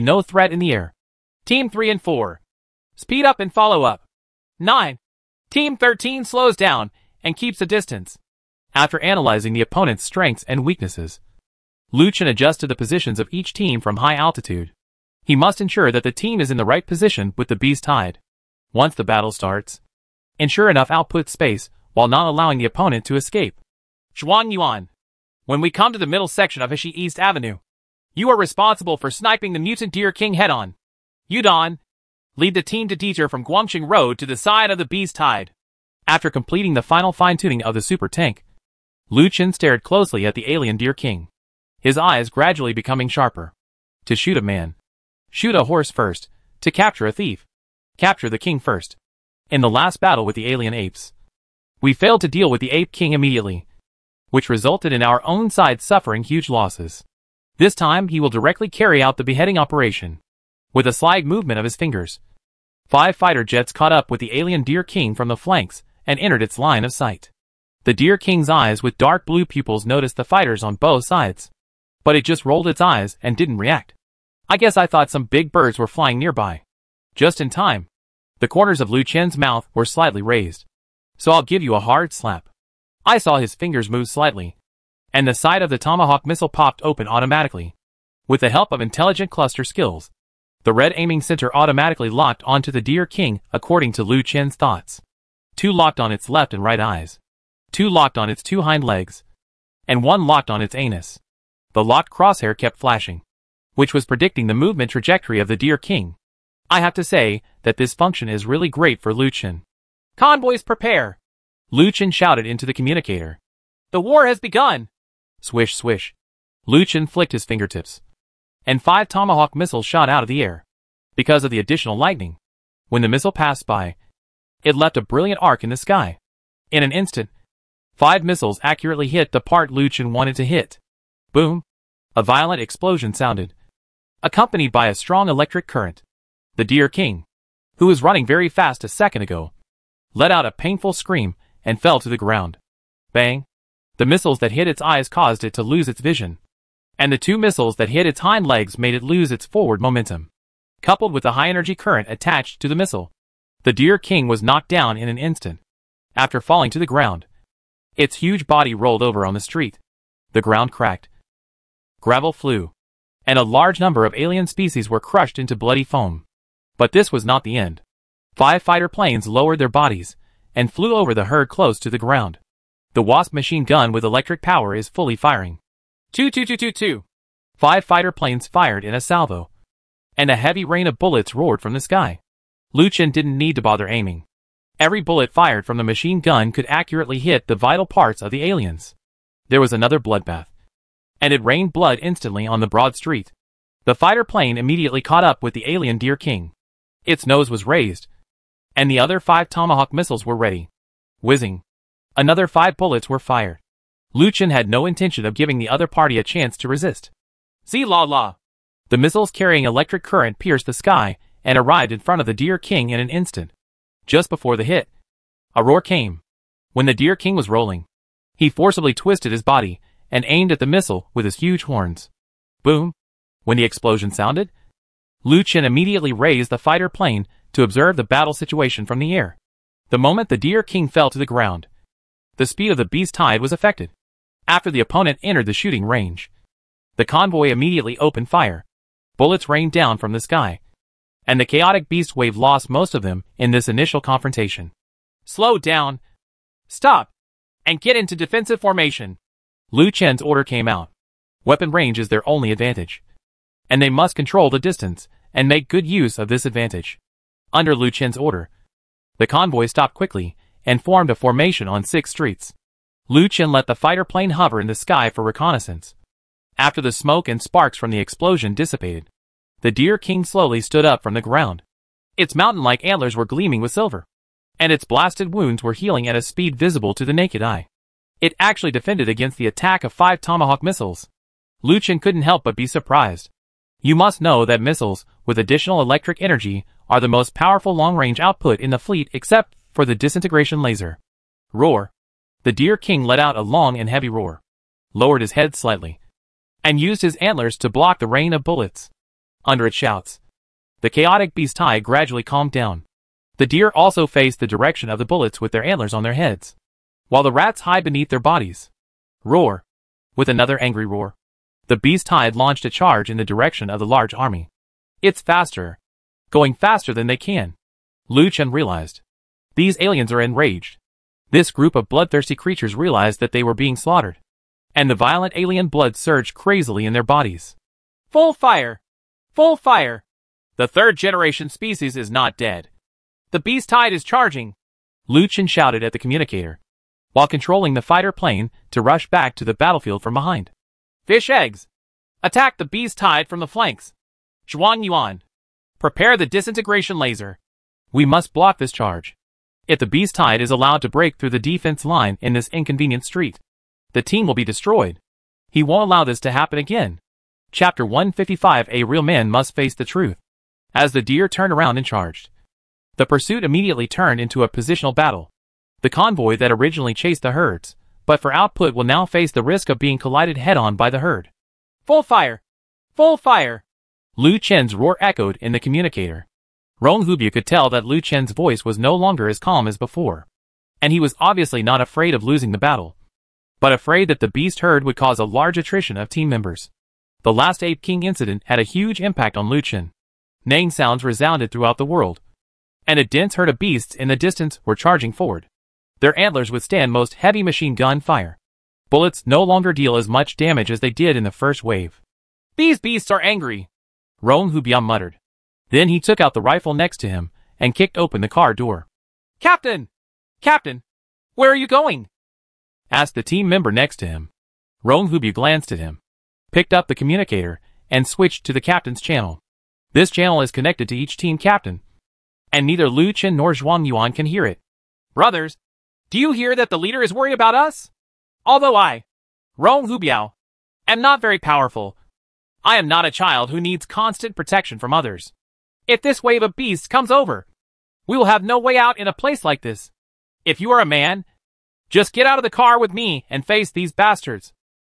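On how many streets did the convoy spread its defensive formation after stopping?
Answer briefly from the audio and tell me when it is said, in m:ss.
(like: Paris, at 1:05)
6, at 4:21.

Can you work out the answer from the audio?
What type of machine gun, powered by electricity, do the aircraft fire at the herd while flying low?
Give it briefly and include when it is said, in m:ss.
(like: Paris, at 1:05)
Wasp, at 2:53.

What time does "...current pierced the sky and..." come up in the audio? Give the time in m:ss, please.
3:30.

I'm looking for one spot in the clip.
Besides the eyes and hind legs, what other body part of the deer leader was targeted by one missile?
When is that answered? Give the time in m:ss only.
1:40.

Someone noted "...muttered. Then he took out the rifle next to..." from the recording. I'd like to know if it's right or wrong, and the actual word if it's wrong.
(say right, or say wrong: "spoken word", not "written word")
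right.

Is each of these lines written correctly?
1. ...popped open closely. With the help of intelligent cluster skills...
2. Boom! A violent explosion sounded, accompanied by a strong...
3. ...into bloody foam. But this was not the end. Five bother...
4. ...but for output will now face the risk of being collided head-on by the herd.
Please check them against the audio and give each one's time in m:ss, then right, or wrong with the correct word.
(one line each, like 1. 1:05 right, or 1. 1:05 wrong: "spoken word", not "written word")
1. 1:26 wrong: "automatically", not "closely"
2. 2:11 right
3. 2:45 wrong: "fighter", not "bother"
4. 6:08 right.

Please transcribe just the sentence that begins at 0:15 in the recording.
He must ensure that the team is in the right position with the beast tide.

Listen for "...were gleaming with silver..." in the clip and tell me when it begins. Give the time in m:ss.
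4:33.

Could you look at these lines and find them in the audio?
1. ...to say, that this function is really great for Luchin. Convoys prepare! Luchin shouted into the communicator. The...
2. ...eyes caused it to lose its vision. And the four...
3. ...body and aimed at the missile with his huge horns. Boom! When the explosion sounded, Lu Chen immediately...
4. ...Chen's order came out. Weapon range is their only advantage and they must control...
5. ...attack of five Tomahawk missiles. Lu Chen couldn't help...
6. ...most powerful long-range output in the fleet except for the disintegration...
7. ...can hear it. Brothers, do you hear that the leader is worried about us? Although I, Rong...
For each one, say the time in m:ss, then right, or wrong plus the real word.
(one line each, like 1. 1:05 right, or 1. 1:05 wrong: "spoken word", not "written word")
1. 1:46 right
2. 2:24 wrong: "two", not "four"
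3. 3:39 right
4. 4:09 right
5. 4:39 right
6. 4:47 right
7. 7:04 right.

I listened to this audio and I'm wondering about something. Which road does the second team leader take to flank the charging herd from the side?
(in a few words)
Guangxing Road.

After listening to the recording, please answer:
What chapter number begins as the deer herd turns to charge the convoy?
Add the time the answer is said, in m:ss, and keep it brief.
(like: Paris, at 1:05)
155, at 5:57.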